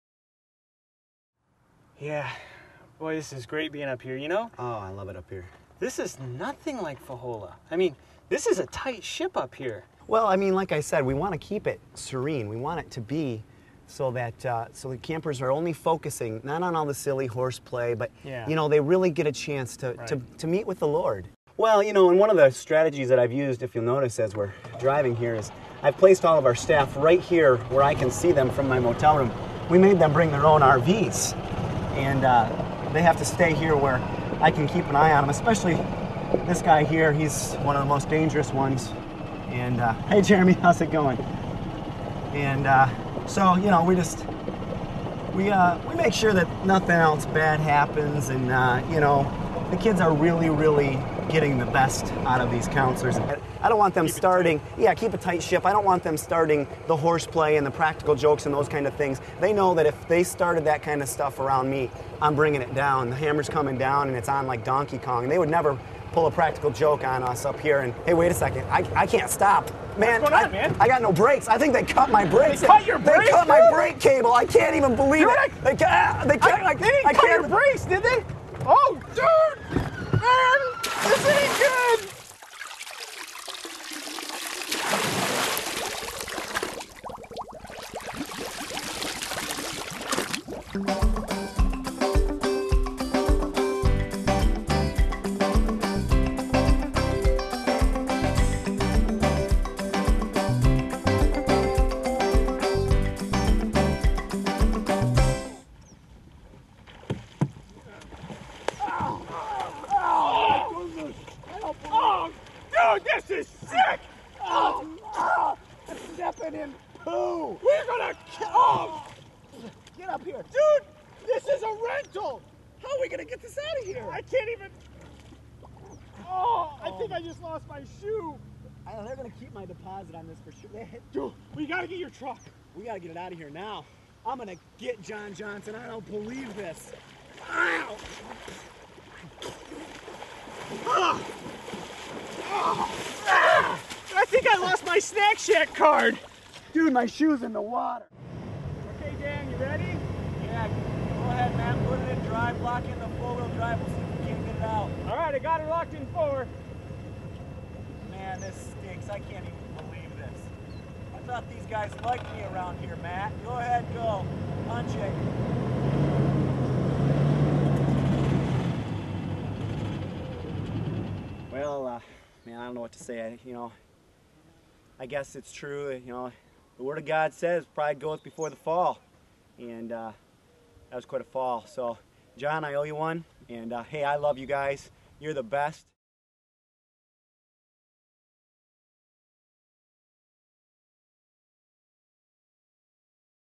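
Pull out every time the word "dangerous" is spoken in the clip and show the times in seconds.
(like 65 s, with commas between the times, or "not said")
38 s.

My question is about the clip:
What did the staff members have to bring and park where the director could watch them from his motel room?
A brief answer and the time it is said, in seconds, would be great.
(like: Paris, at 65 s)
their own RVs, at 30 s.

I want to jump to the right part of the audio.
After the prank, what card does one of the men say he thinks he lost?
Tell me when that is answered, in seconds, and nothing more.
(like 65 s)
144 s.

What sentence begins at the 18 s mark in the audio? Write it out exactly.
you know they really get a chance to, right.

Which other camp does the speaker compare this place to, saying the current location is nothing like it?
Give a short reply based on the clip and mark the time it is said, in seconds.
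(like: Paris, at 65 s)
Fahola, at 7 s.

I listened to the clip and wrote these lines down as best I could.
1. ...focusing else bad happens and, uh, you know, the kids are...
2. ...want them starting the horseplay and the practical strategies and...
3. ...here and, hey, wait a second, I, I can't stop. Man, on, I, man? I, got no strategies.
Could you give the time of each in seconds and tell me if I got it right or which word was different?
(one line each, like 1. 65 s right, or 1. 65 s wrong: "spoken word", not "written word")
1. 46 s wrong: "nothing", not "focusing"
2. 55 s wrong: "jokes", not "strategies"
3. 67 s wrong: "brakes", not "strategies".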